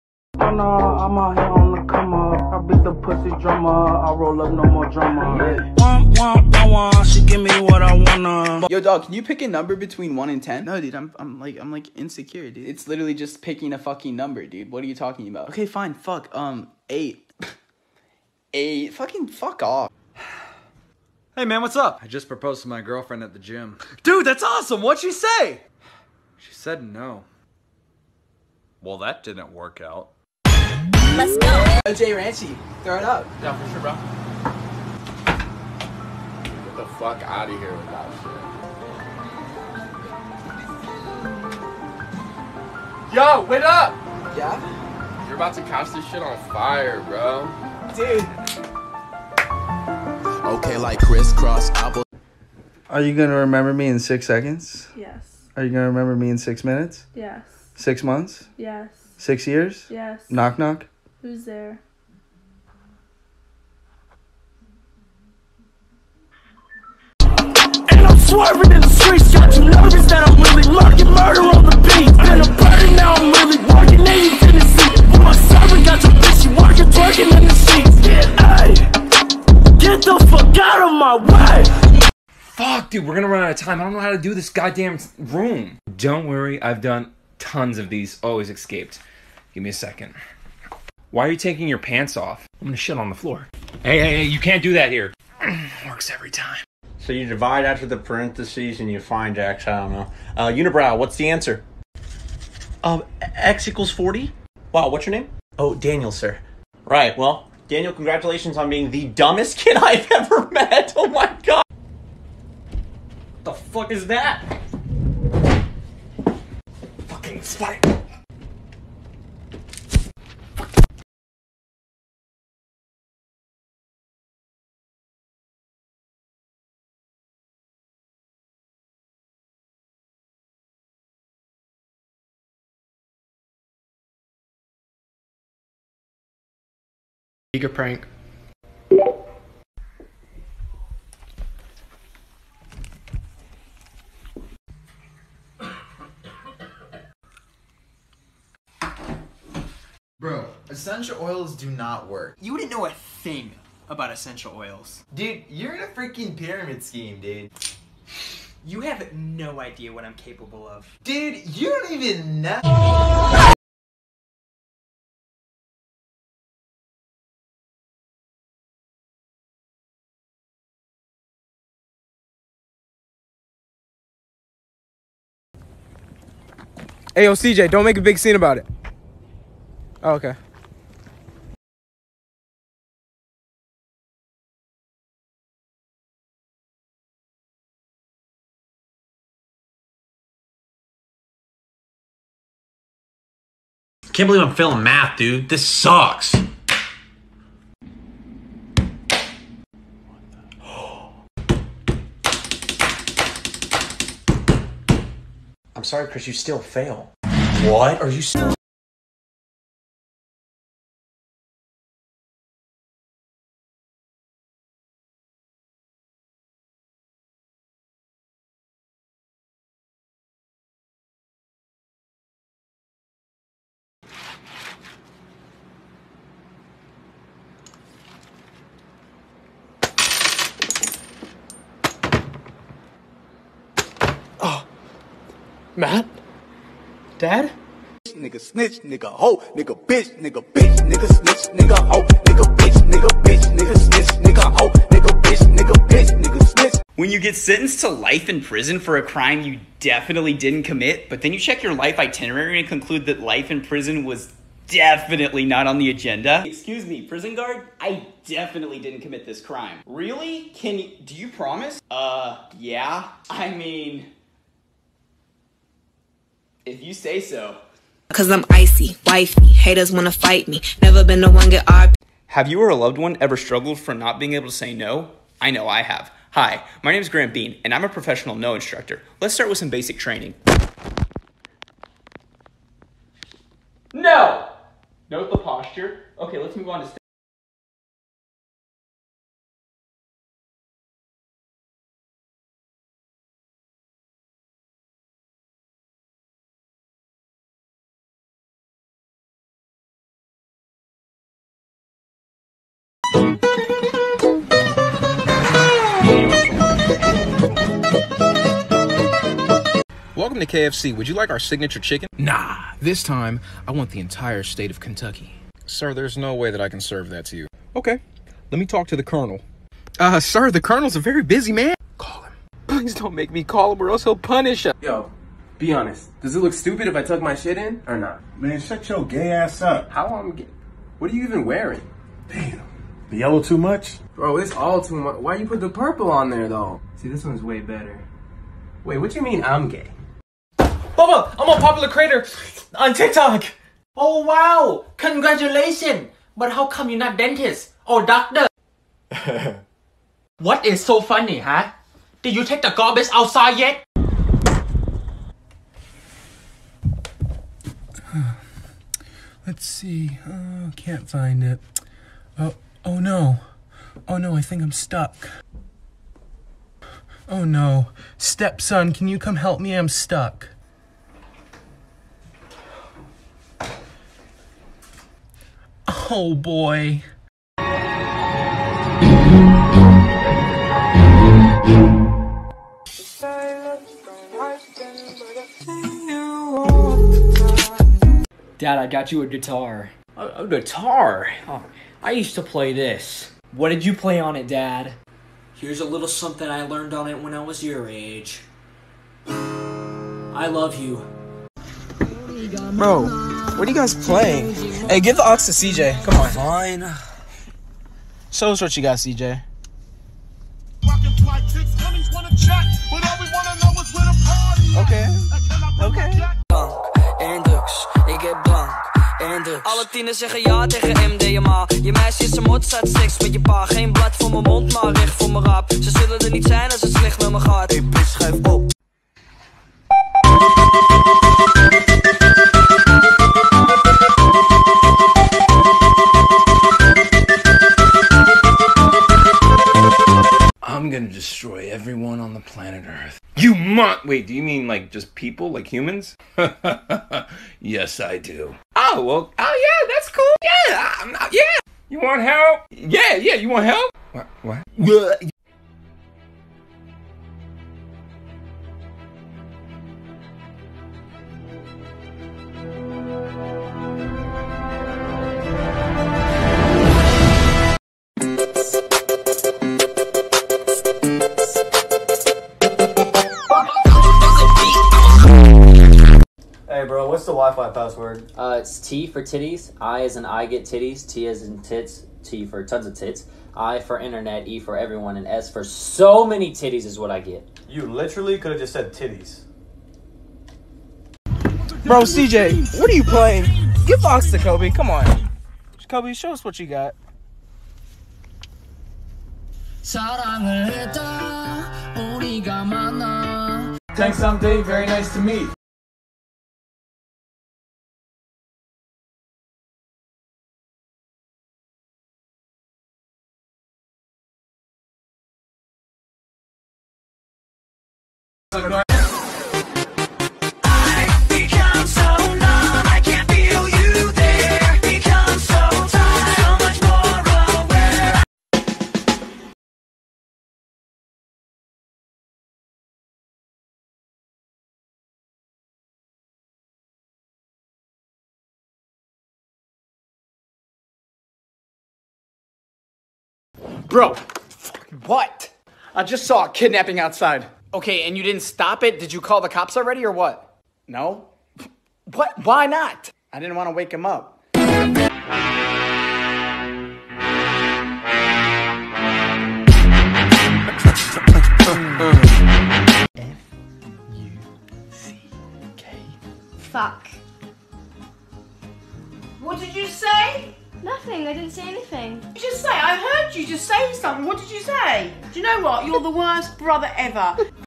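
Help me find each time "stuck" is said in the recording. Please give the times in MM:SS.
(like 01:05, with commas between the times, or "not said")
06:04, 06:09.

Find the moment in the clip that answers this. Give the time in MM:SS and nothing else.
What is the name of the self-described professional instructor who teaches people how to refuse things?
04:37.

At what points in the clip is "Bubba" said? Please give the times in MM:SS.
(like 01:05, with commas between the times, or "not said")
05:41.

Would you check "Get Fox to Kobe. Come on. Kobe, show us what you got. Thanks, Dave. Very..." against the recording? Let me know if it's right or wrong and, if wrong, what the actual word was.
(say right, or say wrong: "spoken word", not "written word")
right.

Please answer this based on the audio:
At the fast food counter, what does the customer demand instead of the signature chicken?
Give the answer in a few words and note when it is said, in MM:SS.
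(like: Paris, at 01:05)
Kentucky, at 05:13.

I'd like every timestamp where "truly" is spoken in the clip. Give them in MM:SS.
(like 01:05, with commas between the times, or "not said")
not said.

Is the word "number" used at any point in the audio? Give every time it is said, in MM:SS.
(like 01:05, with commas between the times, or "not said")
00:09, 00:14.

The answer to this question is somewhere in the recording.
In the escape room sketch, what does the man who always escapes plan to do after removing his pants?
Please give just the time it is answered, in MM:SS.
01:32.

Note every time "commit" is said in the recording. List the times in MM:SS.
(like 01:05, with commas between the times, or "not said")
04:10, 04:19.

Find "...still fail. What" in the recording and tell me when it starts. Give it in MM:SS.
03:26.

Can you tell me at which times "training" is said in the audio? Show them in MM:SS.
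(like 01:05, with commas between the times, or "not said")
04:39.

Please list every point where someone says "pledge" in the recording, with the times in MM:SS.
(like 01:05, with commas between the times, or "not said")
not said.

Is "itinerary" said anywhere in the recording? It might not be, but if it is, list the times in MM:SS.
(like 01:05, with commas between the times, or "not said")
04:11.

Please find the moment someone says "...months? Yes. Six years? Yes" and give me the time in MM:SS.
00:58.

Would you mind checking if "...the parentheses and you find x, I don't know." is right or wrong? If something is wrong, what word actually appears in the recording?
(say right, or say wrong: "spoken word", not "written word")
right.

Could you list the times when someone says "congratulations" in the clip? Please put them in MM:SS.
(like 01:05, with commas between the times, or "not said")
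01:47, 05:44.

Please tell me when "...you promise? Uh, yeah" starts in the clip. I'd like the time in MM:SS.
04:21.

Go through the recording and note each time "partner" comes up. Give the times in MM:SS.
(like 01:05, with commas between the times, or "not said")
not said.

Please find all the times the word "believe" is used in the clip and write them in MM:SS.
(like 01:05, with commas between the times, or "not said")
03:14.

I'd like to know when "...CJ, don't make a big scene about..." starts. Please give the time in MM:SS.
02:57.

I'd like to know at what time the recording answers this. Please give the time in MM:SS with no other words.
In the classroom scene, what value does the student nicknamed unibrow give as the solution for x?
01:43.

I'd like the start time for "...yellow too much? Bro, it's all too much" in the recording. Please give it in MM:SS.
05:33.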